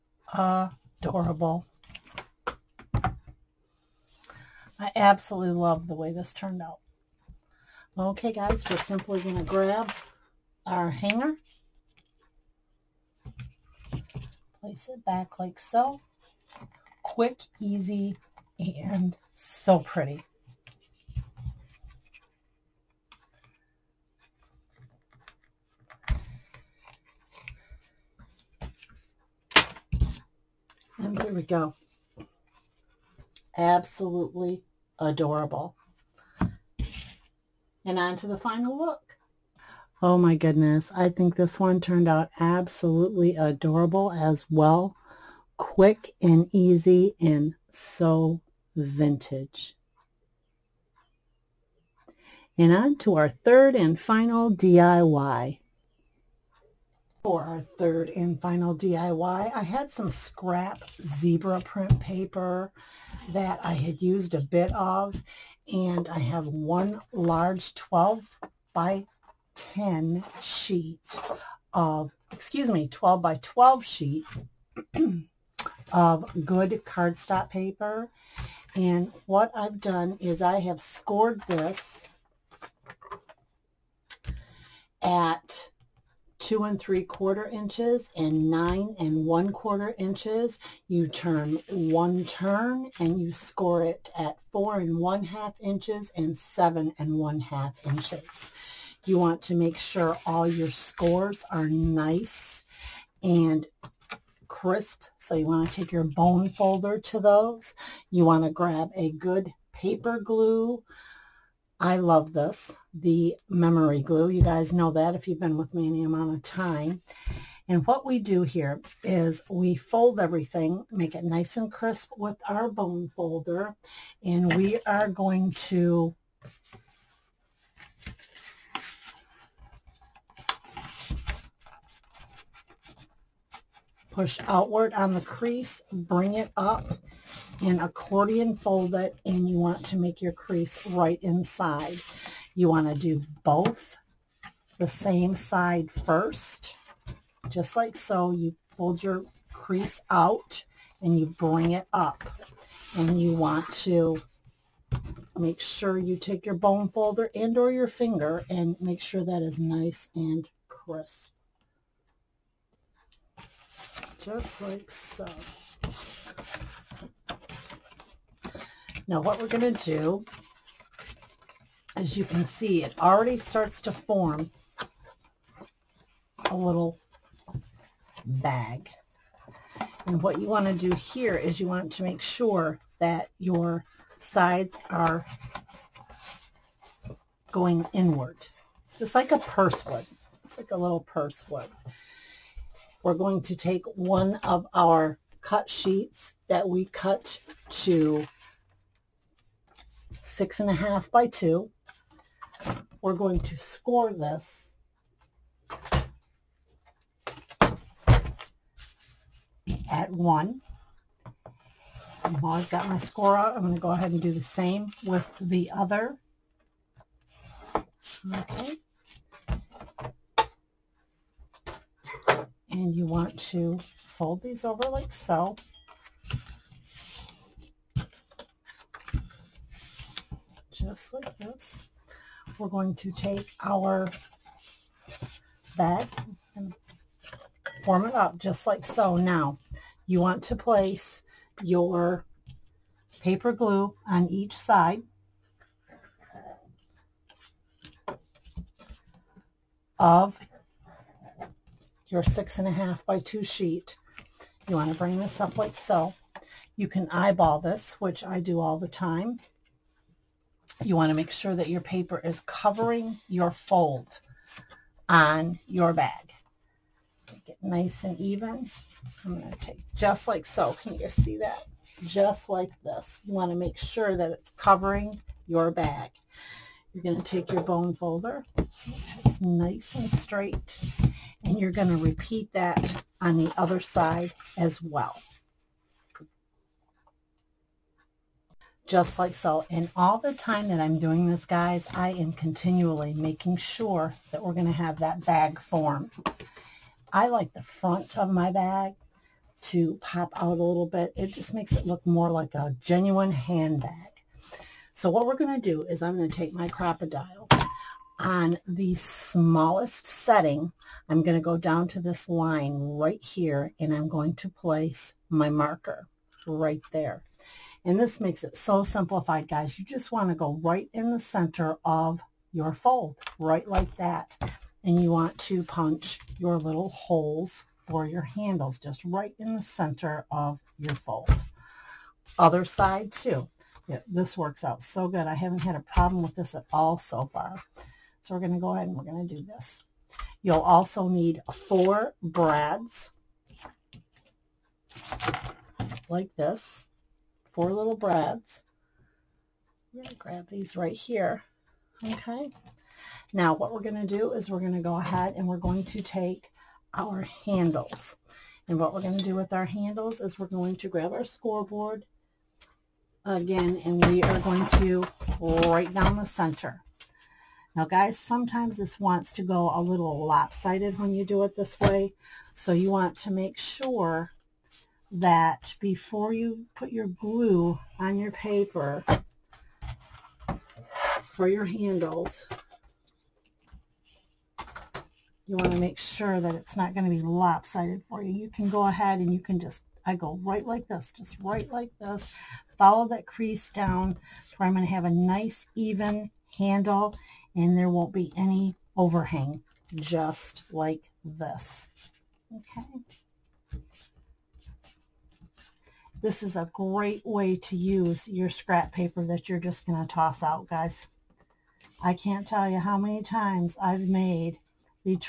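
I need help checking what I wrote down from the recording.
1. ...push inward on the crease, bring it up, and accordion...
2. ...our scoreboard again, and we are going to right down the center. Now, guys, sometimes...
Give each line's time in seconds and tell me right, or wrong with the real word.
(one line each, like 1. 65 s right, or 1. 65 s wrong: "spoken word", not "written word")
1. 134 s wrong: "outward", not "inward"
2. 361 s right.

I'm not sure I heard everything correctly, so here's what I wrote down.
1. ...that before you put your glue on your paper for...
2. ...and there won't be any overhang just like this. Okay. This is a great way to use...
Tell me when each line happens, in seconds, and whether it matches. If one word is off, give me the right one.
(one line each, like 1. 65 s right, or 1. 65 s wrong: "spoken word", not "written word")
1. 375 s right
2. 397 s right.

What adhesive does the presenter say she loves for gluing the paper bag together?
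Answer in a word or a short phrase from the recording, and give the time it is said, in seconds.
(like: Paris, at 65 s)
memory glue, at 112 s.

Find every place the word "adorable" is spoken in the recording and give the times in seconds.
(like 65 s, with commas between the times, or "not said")
0 s, 34 s, 43 s.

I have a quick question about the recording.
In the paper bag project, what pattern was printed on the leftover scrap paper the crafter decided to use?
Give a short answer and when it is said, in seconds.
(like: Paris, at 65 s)
zebra print, at 60 s.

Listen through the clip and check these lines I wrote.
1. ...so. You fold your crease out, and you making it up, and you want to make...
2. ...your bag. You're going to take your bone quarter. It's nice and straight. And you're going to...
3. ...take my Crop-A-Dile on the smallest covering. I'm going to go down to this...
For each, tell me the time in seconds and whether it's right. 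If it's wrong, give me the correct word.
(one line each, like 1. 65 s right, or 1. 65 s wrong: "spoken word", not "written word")
1. 147 s wrong: "bring", not "making"
2. 275 s wrong: "folder", not "quarter"
3. 306 s wrong: "setting", not "covering".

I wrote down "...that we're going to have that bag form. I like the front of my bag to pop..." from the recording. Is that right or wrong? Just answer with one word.
right.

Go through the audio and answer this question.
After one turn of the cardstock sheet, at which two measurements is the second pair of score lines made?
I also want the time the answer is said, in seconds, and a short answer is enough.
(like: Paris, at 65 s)
4 1/2 and 7 1/2 inches, at 94 s.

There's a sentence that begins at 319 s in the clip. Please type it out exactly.
You just want to go right in the center of your fold, right like that.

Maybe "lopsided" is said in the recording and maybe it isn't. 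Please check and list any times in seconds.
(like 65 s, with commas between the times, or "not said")
370 s, 387 s.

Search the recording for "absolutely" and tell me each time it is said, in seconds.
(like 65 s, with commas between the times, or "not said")
4 s, 33 s, 42 s.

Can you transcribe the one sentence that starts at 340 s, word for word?
You'll also need four brads like this, four little brads.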